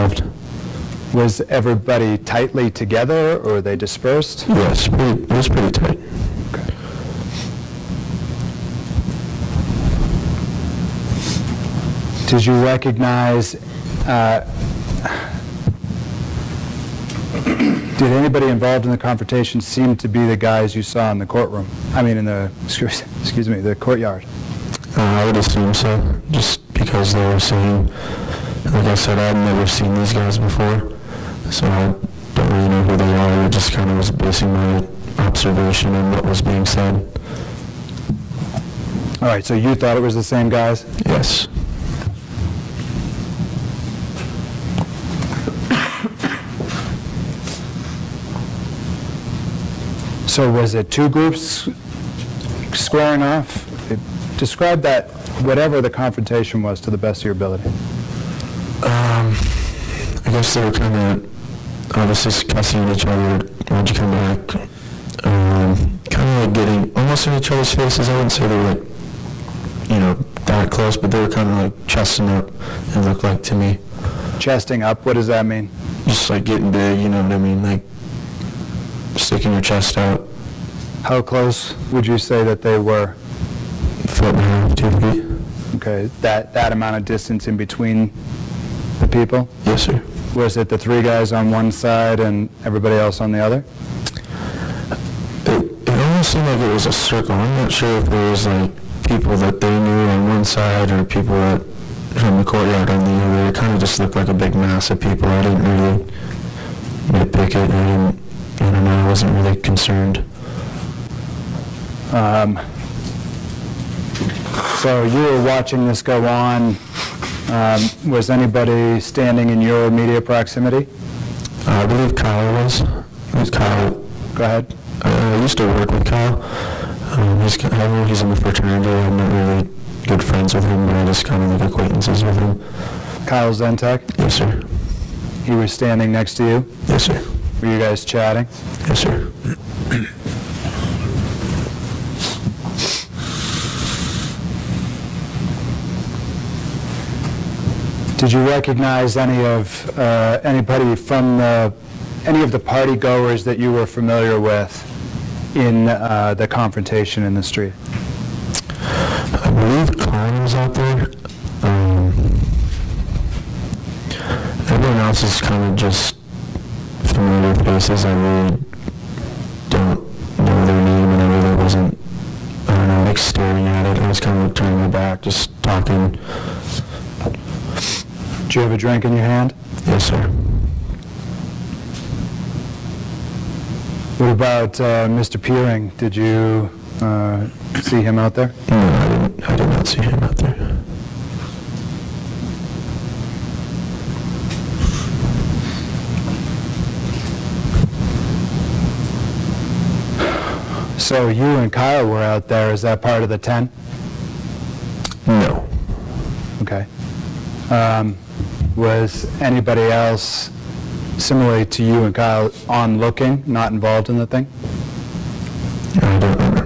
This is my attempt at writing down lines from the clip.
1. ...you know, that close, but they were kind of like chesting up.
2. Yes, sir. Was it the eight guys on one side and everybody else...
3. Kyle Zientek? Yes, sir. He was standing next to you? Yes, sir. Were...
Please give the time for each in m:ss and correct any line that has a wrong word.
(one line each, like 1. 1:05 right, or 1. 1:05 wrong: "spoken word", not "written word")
1. 1:09 right
2. 1:29 wrong: "three", not "eight"
3. 2:13 right.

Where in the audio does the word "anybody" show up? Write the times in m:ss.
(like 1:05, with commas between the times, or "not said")
0:18, 1:58, 2:30, 3:29.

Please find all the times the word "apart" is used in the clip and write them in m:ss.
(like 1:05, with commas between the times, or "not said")
not said.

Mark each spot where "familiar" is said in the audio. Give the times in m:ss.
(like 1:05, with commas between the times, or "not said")
2:33, 2:47.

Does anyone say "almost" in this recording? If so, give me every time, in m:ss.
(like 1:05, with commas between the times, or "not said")
1:06, 1:35.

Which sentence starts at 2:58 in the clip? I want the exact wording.
Do you have a drink in your hand?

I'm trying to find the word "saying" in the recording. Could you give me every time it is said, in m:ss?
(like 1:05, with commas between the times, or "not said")
0:27.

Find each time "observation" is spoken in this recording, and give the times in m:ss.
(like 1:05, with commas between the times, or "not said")
0:35.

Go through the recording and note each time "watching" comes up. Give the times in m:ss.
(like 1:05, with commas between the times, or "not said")
1:55.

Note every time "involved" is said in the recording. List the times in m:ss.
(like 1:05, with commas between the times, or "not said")
0:18, 3:33.